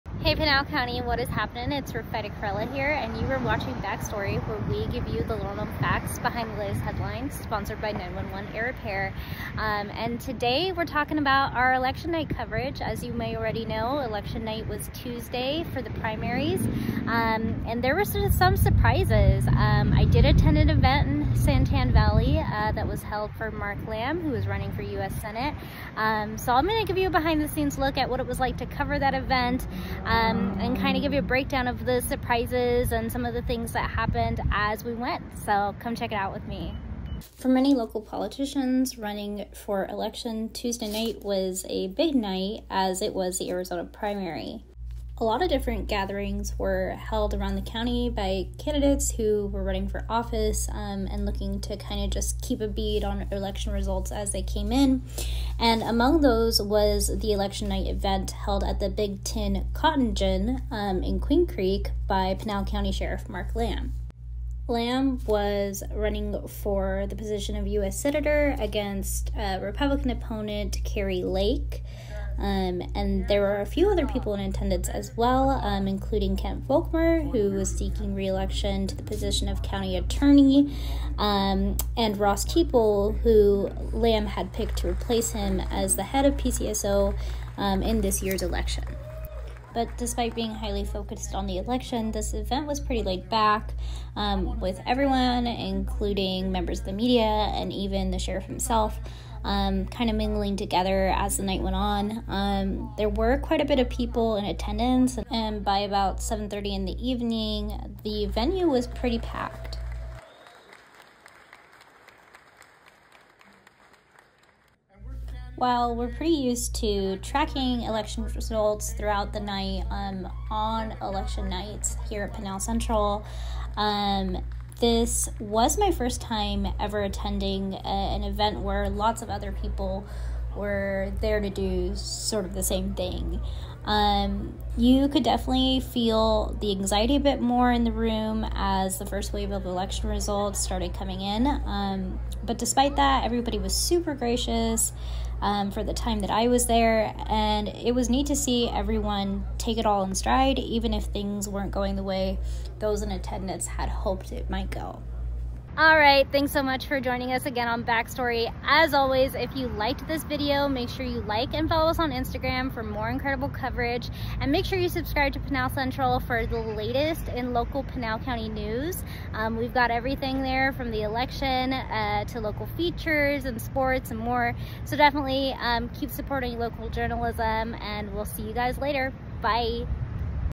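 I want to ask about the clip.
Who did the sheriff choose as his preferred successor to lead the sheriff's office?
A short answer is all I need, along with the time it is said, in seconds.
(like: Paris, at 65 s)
Ross Teeple, at 82 s.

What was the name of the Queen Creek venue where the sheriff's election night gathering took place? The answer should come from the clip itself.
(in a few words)
Big Tin Cotton Gin.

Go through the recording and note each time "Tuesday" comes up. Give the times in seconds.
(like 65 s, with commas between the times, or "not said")
14 s, 40 s.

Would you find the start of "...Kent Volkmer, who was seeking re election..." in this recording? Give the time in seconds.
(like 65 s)
76 s.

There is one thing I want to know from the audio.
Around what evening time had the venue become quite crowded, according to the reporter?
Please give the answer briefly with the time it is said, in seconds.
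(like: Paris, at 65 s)
7:30, at 106 s.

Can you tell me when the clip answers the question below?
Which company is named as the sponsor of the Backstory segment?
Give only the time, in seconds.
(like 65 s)
7 s.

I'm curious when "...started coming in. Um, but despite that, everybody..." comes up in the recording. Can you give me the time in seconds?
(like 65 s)
140 s.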